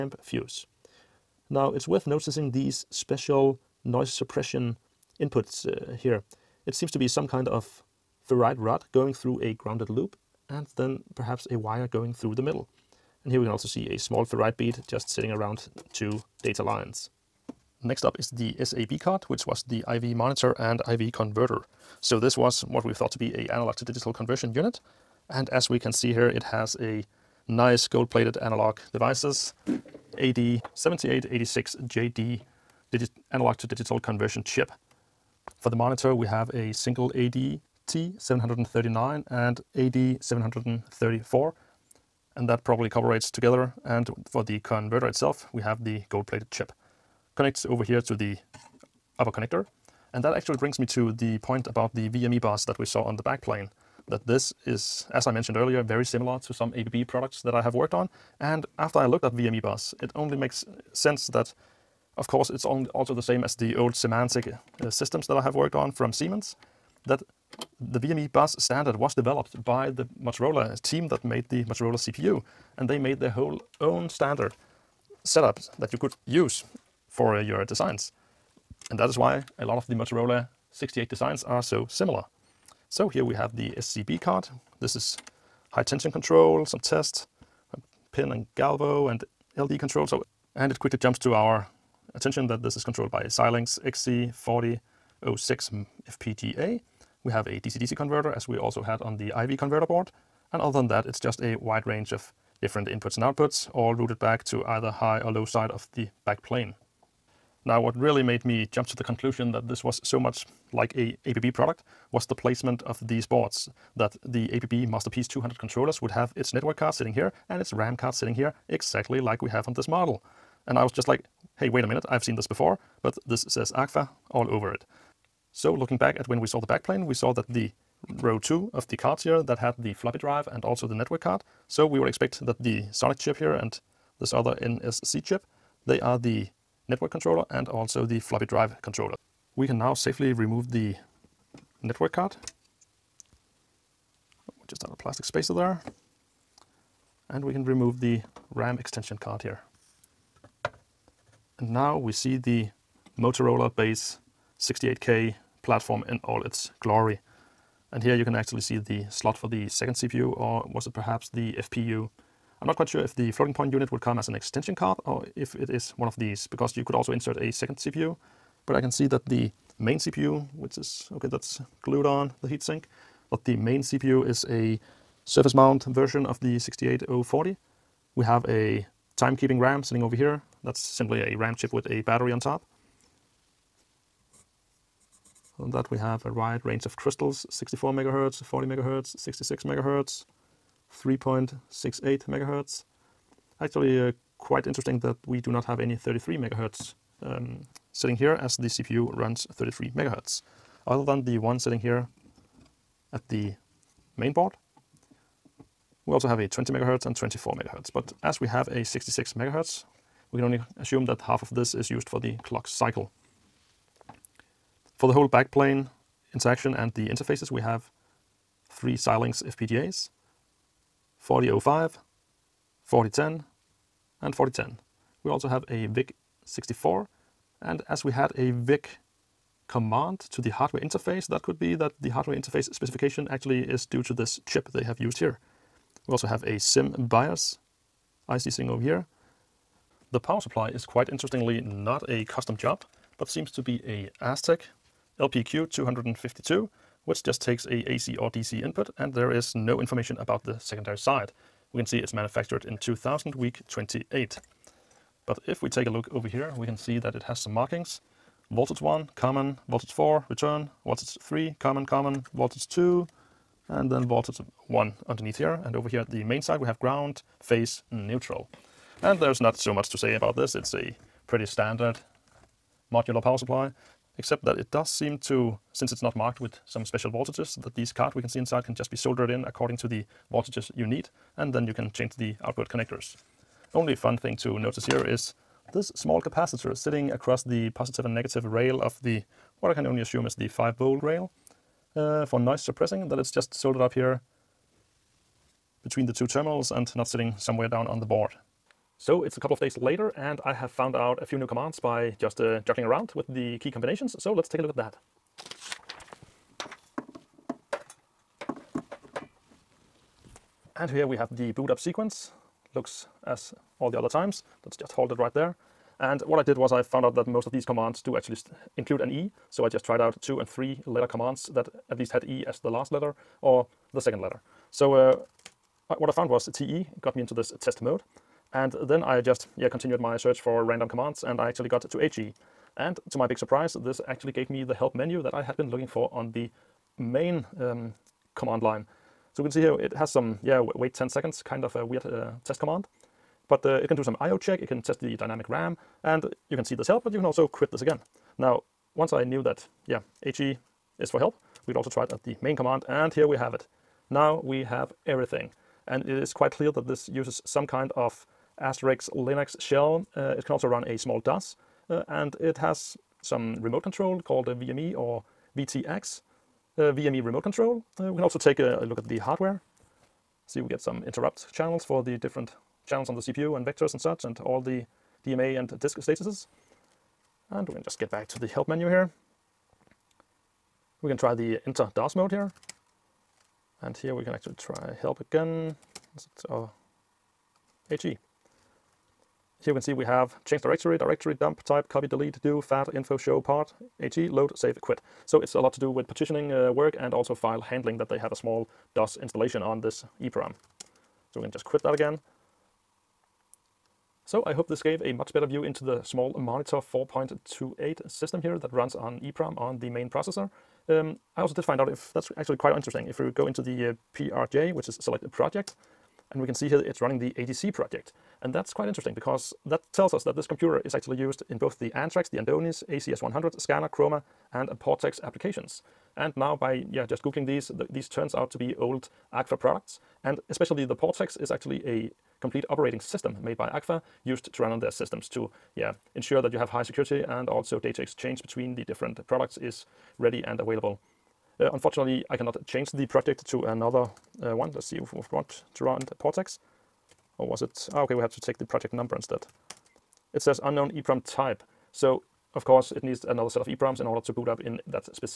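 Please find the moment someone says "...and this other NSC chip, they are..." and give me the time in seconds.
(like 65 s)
133 s.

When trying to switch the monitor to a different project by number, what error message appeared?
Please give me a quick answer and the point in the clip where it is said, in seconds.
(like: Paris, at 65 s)
Unknown EEPROM type, at 450 s.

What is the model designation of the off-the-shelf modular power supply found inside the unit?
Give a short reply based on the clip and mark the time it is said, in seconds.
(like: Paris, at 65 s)
Astec LPQ 252, at 244 s.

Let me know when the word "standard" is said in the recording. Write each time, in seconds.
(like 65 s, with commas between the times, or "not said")
68 s, 74 s, 271 s.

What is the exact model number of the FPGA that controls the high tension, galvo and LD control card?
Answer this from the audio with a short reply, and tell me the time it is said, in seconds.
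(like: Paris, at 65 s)
XC4006, at 95 s.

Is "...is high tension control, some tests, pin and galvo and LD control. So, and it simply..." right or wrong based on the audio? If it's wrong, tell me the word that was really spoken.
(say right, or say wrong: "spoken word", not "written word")
wrong: "quickly", not "simply".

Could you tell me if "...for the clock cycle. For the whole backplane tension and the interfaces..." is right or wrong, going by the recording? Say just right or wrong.
wrong.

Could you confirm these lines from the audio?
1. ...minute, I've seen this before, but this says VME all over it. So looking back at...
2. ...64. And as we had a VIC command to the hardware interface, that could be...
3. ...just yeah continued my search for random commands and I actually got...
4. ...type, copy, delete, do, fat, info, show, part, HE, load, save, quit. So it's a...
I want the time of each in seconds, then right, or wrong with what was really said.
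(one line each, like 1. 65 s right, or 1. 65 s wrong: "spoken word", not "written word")
1. 121 s wrong: "AGFA", not "VME"
2. 226 s right
3. 329 s right
4. 391 s right.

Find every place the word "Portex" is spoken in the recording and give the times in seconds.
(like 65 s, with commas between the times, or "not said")
424 s, 430 s, 446 s.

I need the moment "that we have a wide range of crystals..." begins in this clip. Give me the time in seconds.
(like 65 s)
185 s.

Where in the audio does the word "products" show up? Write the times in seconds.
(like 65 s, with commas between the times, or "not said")
57 s, 111 s, 429 s, 439 s.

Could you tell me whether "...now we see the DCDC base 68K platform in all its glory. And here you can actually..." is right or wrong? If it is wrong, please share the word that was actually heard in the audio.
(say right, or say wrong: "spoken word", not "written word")
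wrong: "Motorola", not "DCDC".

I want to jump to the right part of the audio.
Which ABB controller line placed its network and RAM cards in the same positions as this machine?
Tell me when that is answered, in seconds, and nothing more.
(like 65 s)
114 s.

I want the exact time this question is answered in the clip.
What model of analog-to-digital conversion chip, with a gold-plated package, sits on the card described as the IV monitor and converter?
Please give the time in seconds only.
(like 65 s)
30 s.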